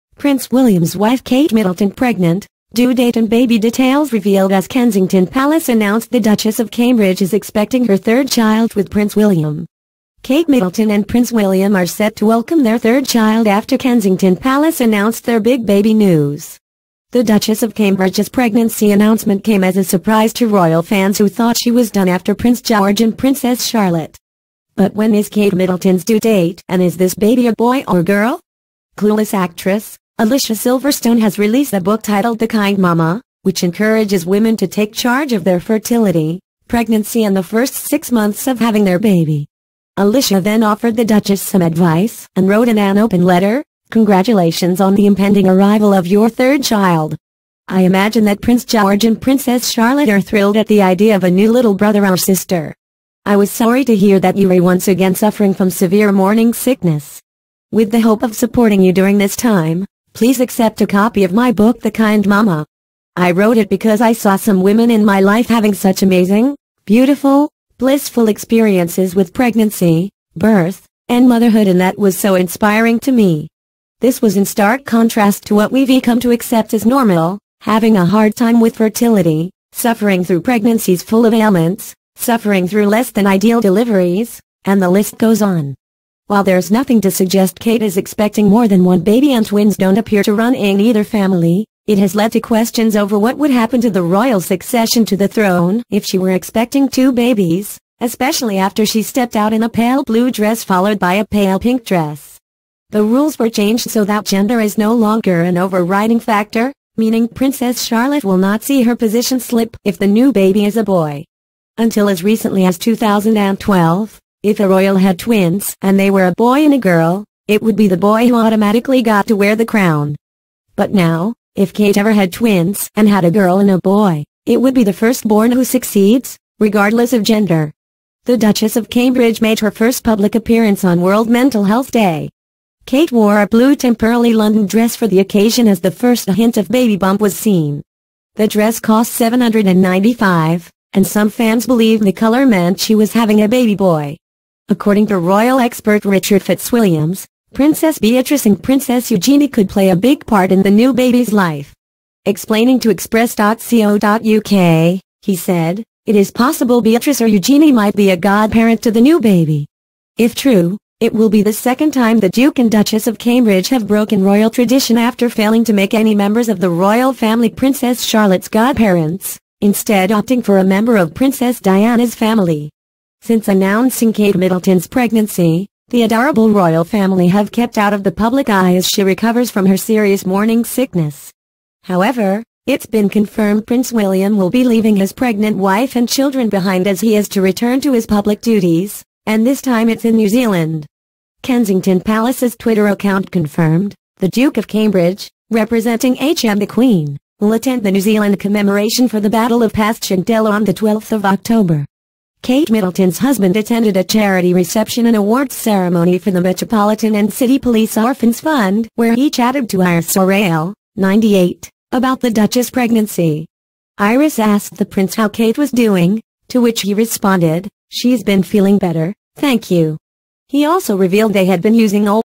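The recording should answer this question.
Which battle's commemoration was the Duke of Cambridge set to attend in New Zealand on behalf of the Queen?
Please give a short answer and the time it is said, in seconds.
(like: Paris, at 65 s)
Battle of Passchendaele, at 199 s.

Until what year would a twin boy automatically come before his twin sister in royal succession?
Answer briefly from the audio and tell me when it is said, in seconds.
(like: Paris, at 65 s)
2012, at 112 s.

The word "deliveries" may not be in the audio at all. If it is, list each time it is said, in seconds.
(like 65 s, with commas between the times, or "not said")
83 s.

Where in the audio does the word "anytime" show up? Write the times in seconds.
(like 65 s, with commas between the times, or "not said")
not said.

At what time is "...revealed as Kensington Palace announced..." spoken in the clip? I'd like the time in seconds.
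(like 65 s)
4 s.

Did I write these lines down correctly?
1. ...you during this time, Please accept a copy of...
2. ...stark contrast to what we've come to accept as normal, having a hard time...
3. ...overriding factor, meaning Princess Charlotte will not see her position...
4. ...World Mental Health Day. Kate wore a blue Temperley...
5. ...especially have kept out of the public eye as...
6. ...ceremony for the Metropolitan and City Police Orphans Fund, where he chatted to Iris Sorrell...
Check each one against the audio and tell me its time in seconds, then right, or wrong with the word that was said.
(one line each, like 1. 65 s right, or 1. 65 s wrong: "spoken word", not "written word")
1. 58 s right
2. 74 s right
3. 105 s right
4. 131 s right
5. 176 s wrong: "family", not "especially"
6. 205 s right.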